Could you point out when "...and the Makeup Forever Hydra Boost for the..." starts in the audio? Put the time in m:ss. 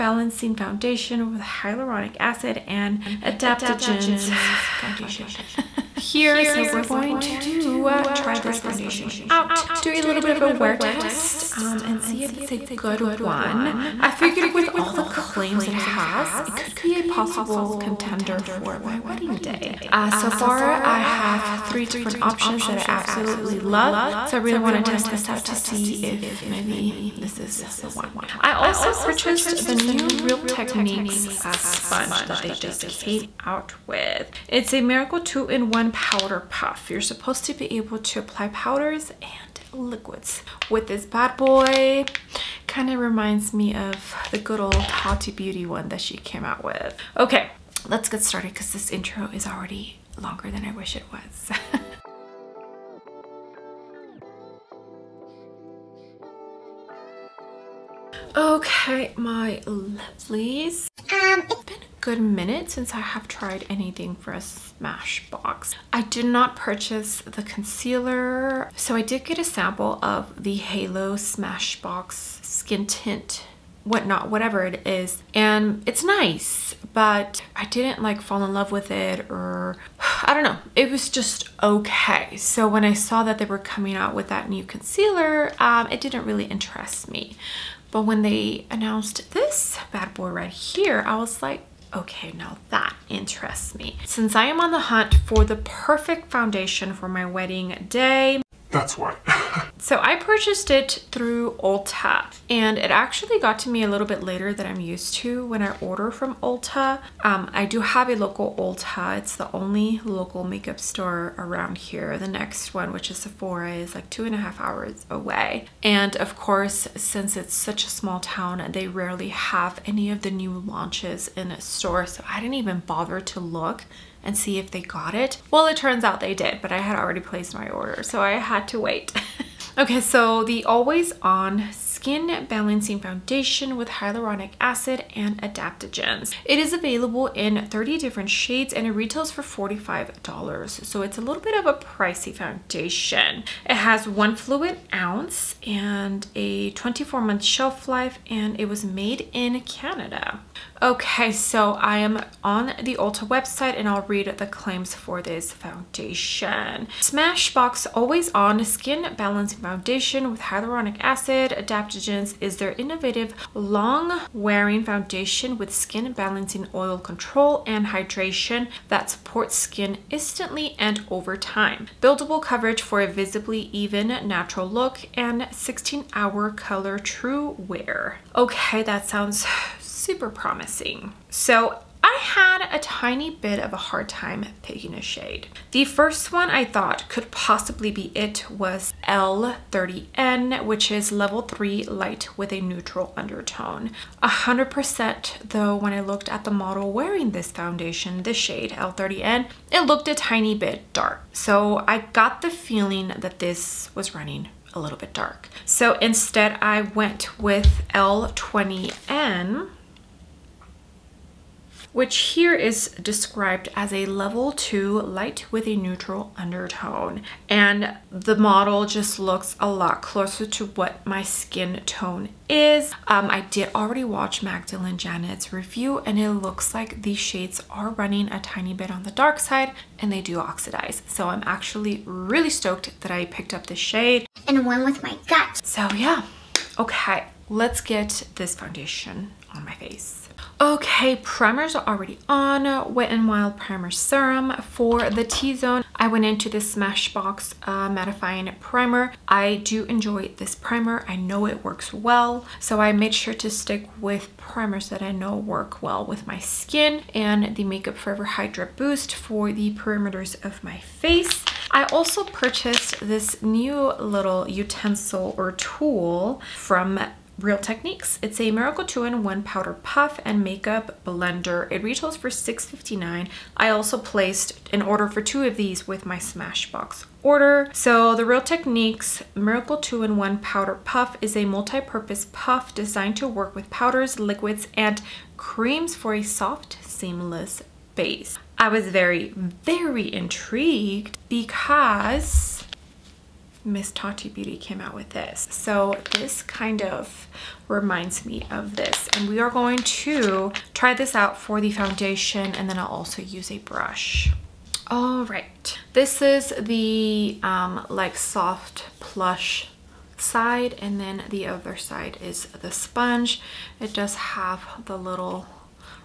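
4:17.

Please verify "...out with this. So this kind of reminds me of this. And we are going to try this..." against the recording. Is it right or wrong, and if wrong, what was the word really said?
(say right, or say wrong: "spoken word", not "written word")
right.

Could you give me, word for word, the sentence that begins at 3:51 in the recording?
So I'm actually really stoked that I picked up this shade.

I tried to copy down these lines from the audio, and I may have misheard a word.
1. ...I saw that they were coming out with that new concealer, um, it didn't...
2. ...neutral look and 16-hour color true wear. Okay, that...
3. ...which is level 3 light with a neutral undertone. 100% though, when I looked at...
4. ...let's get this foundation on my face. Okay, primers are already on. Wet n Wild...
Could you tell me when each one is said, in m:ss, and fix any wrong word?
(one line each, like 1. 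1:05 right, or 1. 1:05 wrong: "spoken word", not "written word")
1. 1:22 right
2. 2:54 wrong: "natural", not "neutral"
3. 3:10 right
4. 3:57 right.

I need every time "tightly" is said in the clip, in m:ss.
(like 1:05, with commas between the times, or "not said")
not said.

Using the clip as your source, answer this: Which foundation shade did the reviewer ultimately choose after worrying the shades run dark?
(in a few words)
L20N.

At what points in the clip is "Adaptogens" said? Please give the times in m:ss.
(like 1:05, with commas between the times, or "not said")
0:03, 2:15, 2:41.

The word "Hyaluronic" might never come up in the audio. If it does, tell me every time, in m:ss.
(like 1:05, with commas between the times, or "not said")
0:01, 2:13, 2:40.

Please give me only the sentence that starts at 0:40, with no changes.
With this bad boy, kind of reminds me of the good old Tati Beauty one that she came out with.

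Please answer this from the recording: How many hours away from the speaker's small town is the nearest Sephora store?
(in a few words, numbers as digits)
2.5 hours.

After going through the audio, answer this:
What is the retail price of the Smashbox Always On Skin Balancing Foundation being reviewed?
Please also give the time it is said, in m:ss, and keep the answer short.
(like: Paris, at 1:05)
$45, at 2:19.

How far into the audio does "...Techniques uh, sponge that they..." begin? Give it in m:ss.
0:30.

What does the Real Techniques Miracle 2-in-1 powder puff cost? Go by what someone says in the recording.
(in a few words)
$6.59.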